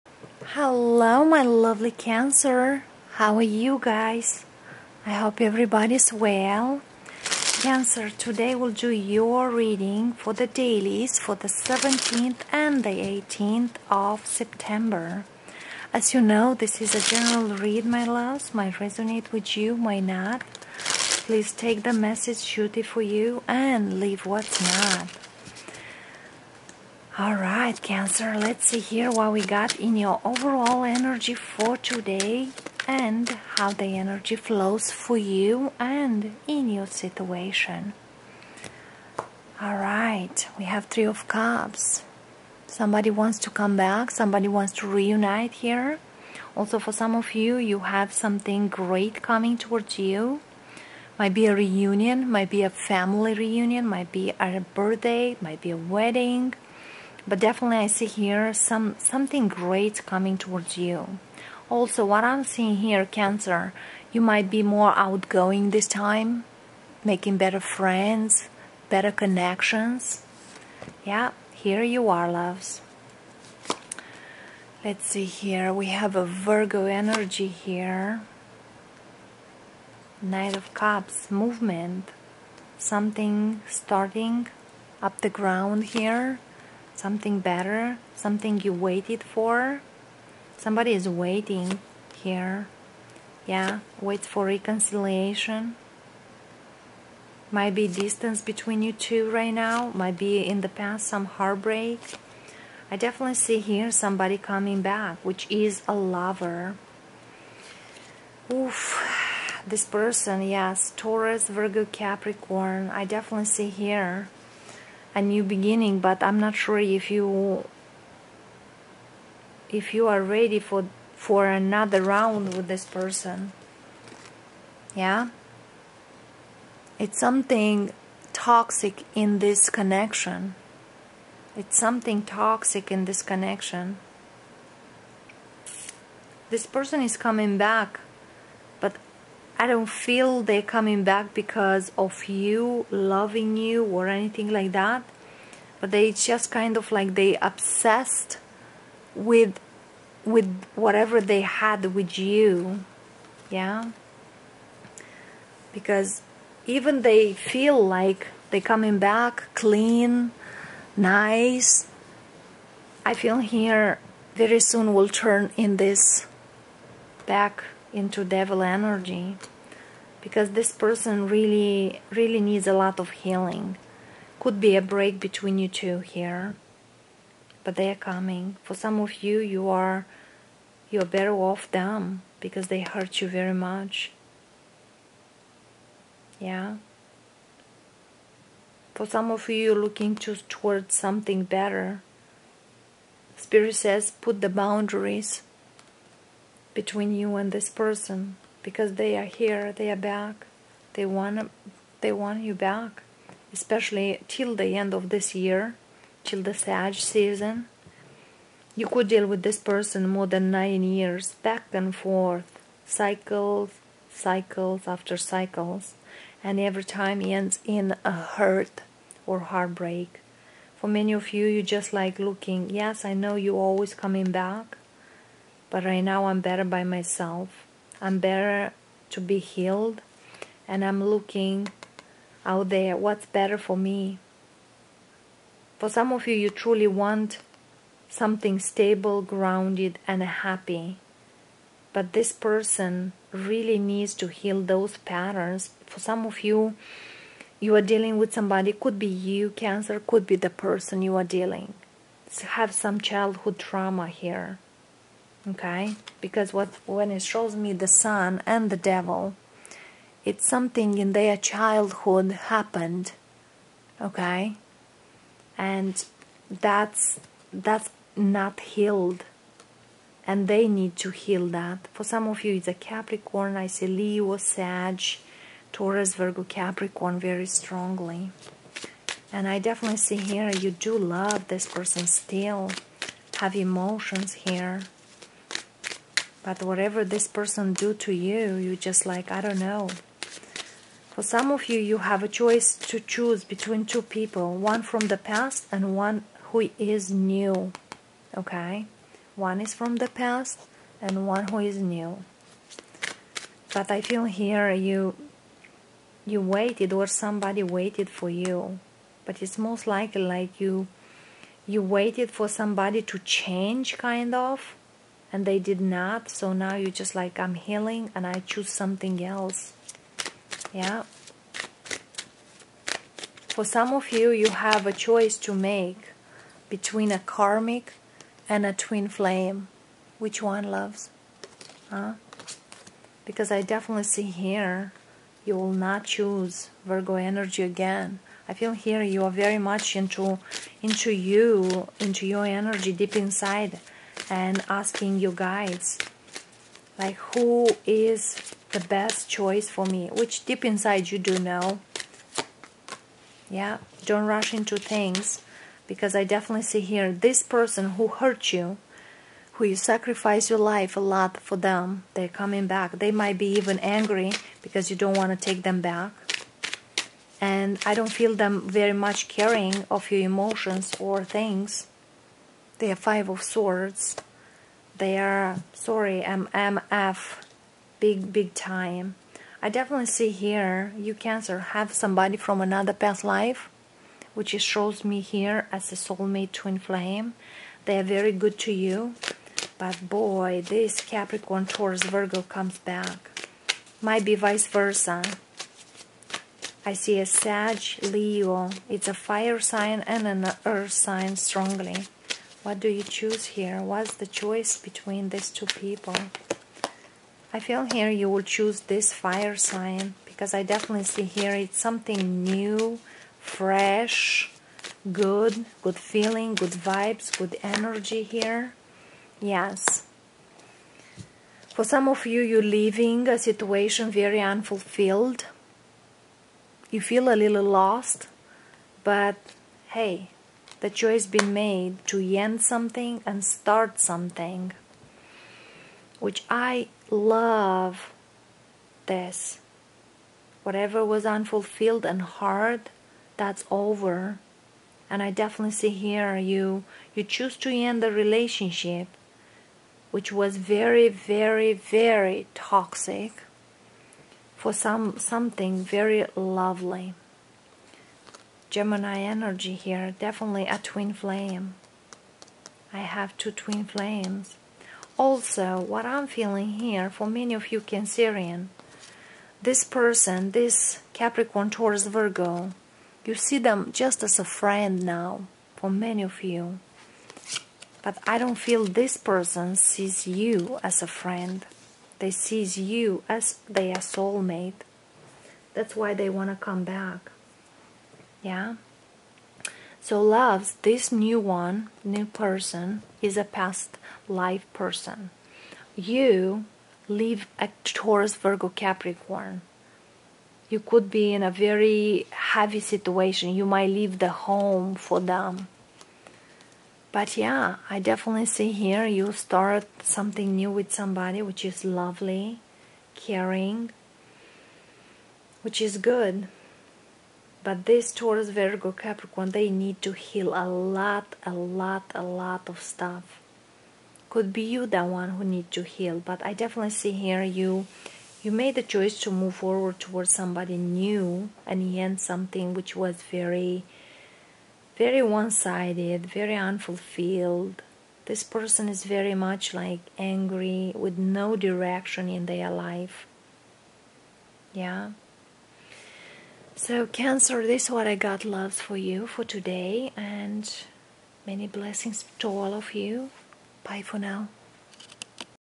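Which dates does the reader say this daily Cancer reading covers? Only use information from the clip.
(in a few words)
17th and 18th of September.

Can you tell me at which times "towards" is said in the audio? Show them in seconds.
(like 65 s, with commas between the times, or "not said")
49 s, 60 s, 190 s, 529 s.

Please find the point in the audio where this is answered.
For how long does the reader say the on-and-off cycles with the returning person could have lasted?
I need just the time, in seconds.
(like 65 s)
210 s.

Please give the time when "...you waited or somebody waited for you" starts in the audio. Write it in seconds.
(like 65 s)
306 s.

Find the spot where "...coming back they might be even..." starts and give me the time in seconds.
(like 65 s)
362 s.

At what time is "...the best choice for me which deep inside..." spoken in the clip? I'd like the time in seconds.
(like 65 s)
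348 s.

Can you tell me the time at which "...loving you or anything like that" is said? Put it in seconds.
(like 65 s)
142 s.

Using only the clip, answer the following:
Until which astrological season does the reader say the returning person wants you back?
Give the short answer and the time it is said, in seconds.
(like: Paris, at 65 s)
Sag season, at 206 s.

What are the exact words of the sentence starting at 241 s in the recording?
But this person really needs to heal those patterns.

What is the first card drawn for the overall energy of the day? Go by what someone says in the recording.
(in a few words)
Three of Cups.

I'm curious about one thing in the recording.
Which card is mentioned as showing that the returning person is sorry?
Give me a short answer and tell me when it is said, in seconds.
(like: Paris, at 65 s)
Five of Swords, at 372 s.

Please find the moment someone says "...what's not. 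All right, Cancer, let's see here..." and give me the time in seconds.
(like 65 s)
24 s.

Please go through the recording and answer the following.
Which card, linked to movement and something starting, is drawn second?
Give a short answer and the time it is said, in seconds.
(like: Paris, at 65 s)
Knight of Cups, at 80 s.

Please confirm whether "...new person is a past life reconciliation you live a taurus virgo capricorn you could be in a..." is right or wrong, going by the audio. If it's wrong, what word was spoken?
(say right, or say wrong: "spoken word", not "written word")
wrong: "person", not "reconciliation".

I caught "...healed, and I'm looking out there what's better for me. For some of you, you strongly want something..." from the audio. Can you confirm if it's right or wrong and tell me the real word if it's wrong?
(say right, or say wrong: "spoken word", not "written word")
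wrong: "truly", not "strongly".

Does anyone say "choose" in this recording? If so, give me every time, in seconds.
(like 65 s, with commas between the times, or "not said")
292 s, 318 s, 336 s, 403 s, 408 s, 447 s.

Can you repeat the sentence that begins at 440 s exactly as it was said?
Whatever was unfulfilled and hard, that's over.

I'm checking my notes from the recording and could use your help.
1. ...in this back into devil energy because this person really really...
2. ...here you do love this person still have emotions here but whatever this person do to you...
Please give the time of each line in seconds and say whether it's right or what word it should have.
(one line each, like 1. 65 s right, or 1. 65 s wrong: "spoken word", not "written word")
1. 165 s right
2. 280 s right.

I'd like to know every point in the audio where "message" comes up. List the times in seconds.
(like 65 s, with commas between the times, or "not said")
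21 s.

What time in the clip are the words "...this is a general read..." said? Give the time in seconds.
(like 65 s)
16 s.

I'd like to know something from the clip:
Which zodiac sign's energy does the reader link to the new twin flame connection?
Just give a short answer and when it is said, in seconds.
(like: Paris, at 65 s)
Gemini, at 458 s.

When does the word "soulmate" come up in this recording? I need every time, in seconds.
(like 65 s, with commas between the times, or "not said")
385 s, 483 s.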